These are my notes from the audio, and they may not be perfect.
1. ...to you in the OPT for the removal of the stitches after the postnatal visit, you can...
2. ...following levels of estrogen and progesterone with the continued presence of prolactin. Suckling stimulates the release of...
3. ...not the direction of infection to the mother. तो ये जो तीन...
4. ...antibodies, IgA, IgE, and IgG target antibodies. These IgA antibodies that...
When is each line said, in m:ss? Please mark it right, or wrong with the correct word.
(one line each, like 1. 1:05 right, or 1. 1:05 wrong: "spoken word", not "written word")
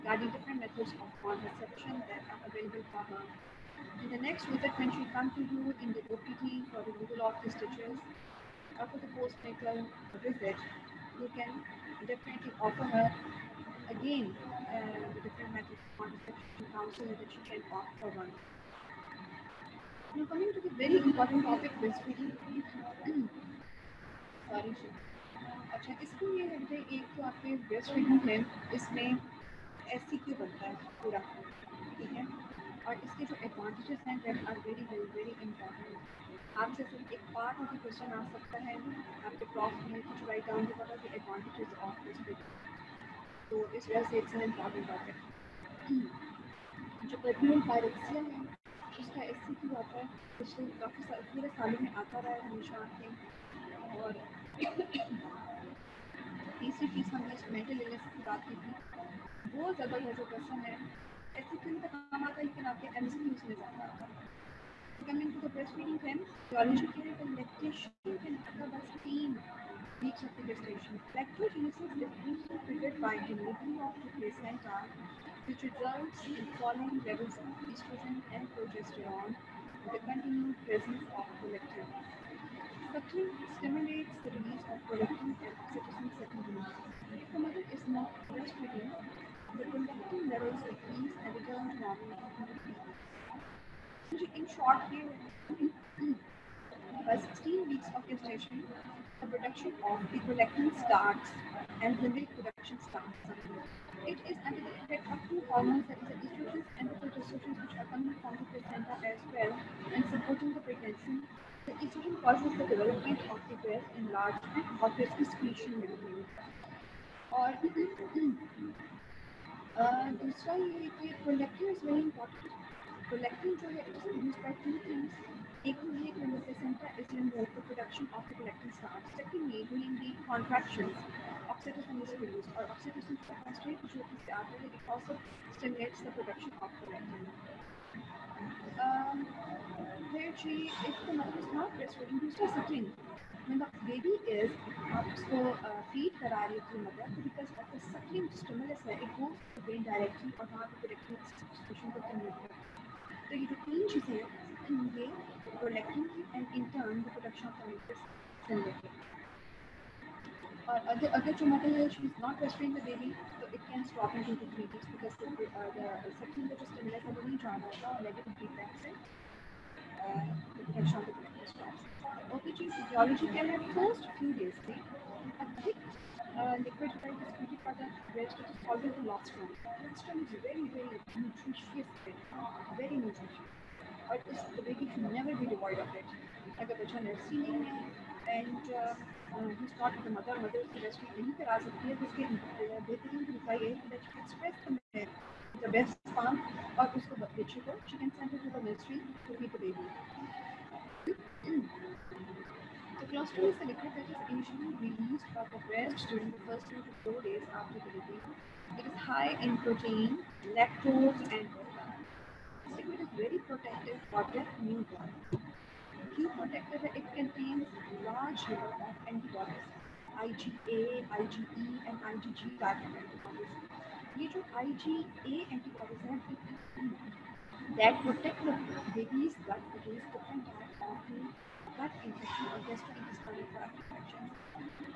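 1. 0:05 right
2. 1:16 right
3. 2:30 wrong: "substitution", not "infection"
4. 3:39 right.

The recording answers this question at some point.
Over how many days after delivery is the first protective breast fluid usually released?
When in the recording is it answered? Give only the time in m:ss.
3:26.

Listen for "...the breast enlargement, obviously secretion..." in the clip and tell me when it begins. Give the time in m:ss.
1:53.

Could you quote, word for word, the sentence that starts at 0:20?
Now coming to the very important topic breastfeeding.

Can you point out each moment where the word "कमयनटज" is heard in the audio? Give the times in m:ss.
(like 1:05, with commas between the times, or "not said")
2:37, 2:51.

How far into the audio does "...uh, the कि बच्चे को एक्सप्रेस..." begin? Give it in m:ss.
3:13.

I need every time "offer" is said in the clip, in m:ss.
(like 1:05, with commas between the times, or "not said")
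0:12.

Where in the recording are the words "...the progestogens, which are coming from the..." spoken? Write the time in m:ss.
1:46.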